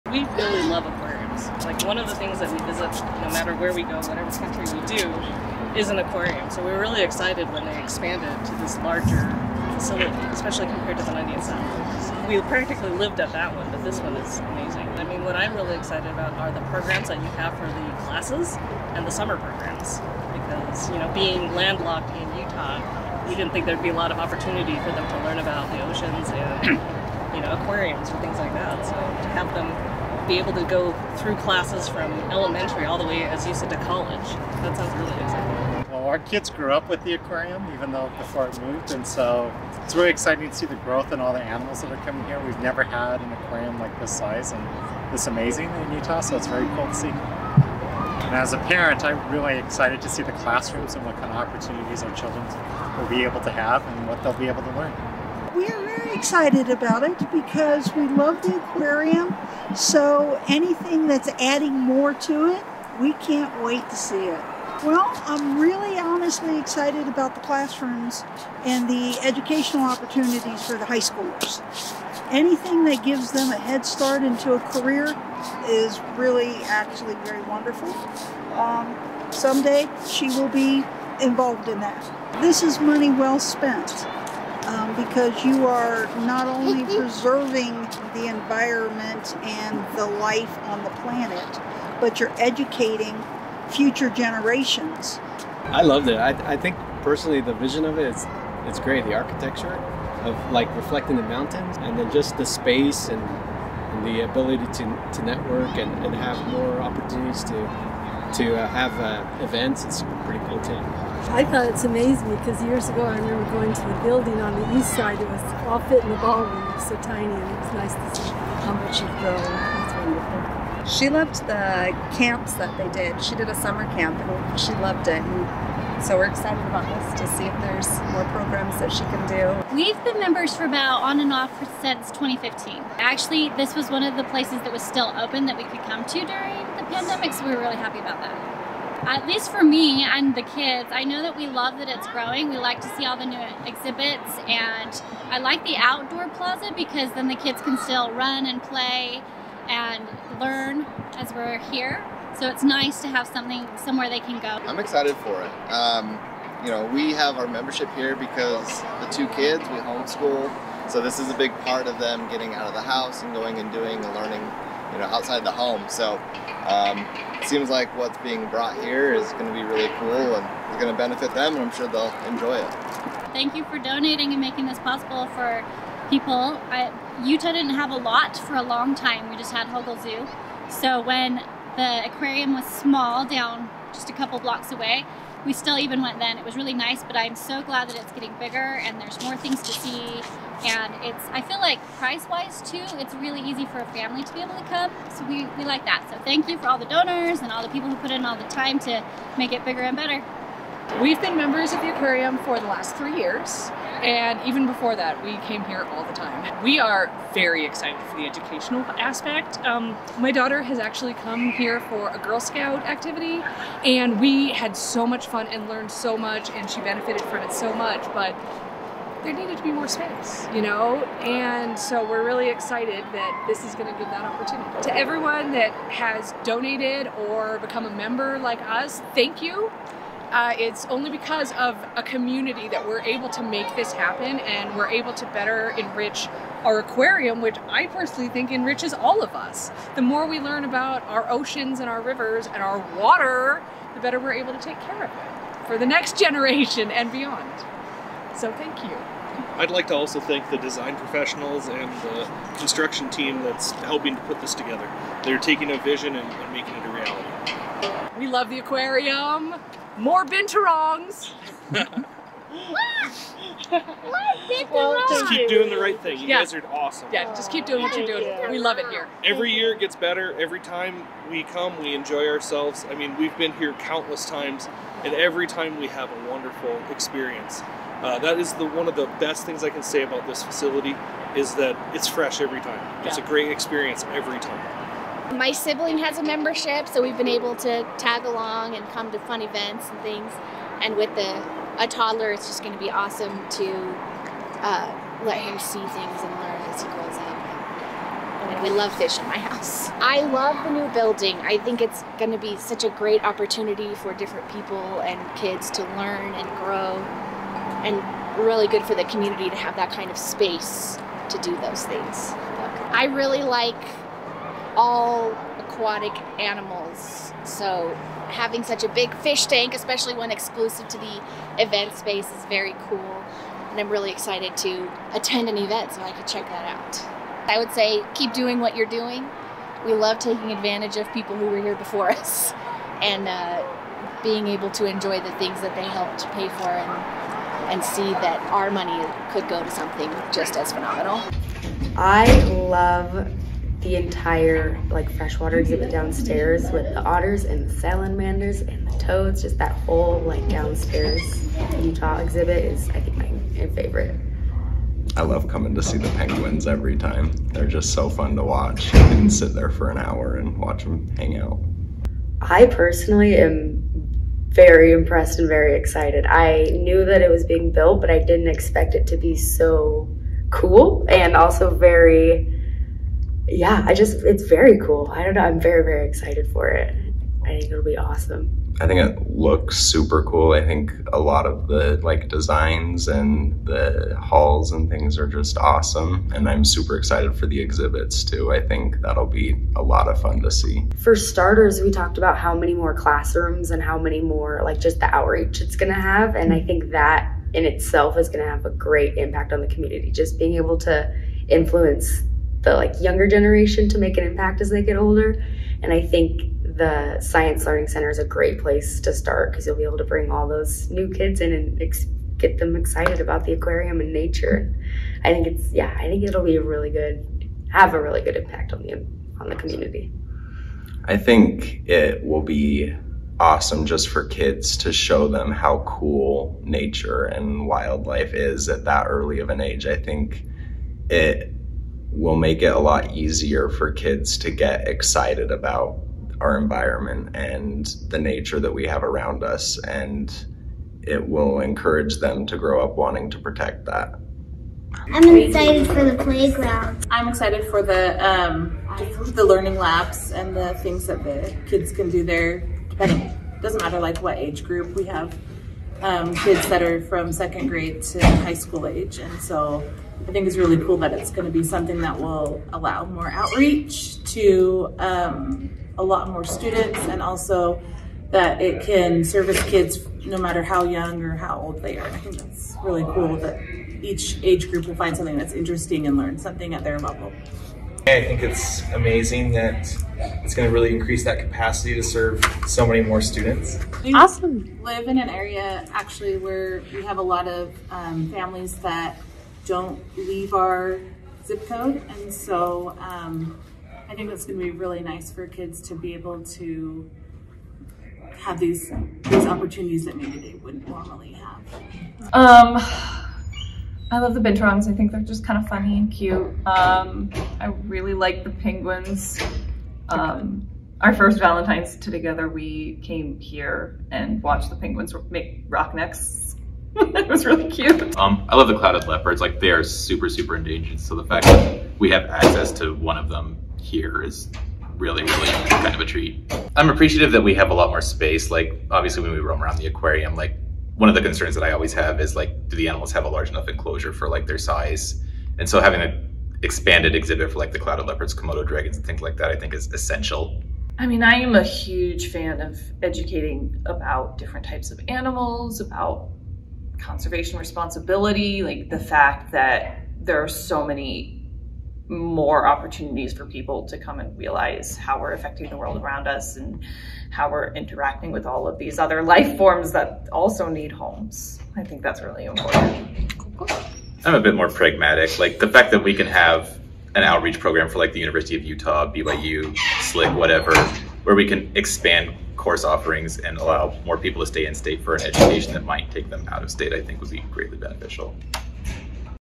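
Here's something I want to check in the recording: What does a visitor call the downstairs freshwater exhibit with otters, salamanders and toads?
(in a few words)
Utah exhibit.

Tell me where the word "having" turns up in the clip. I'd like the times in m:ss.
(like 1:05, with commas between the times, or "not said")
5:18, 8:55.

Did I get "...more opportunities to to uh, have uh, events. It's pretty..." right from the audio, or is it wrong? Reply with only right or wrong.
right.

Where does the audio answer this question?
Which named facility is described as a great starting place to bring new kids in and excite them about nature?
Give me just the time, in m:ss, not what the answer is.
6:47.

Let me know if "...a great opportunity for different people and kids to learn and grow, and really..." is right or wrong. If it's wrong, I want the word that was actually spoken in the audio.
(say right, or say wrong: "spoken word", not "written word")
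right.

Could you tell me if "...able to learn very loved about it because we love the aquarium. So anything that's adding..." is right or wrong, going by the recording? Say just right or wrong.
wrong.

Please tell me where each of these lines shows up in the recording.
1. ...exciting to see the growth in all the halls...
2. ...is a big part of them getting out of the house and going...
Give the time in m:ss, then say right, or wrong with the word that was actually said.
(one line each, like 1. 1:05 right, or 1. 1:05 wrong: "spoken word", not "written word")
1. 0:40 wrong: "animals", not "halls"
2. 2:41 right.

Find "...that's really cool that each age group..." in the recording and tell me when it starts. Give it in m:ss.
7:52.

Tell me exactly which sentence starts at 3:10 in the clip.
And it's, I feel like price-wise too, it's really easy for a family to be able to come.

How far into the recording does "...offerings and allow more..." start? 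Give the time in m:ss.
9:32.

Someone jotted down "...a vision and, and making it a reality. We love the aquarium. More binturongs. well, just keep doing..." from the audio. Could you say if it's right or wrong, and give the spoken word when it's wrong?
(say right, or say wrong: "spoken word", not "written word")
right.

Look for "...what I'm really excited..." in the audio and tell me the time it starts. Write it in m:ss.
0:15.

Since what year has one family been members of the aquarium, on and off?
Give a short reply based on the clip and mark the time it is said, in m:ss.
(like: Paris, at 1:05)
2015, at 2:12.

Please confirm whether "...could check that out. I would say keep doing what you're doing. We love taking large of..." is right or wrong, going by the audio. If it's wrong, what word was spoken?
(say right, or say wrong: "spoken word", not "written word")
wrong: "advantage", not "large".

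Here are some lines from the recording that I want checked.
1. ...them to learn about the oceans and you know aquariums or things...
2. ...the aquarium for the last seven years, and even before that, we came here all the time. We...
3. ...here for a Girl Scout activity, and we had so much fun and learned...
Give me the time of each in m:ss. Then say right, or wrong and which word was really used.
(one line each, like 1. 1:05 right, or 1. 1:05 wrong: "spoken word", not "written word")
1. 0:24 right
2. 3:21 wrong: "three", not "seven"
3. 3:31 right.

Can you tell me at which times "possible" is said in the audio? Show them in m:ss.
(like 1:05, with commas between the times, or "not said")
2:54.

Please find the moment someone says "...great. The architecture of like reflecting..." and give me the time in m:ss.
1:38.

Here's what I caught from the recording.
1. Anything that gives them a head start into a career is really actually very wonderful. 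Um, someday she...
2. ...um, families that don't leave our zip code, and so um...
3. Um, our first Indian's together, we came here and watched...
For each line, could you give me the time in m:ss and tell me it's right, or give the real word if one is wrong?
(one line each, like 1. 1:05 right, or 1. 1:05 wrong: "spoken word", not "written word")
1. 1:12 right
2. 8:07 right
3. 8:30 wrong: "Valentine", not "Indian".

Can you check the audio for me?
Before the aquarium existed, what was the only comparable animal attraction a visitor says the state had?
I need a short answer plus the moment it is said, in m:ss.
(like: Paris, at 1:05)
Hogle Zoo, at 2:59.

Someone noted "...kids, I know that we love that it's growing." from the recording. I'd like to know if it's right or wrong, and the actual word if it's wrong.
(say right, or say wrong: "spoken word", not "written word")
right.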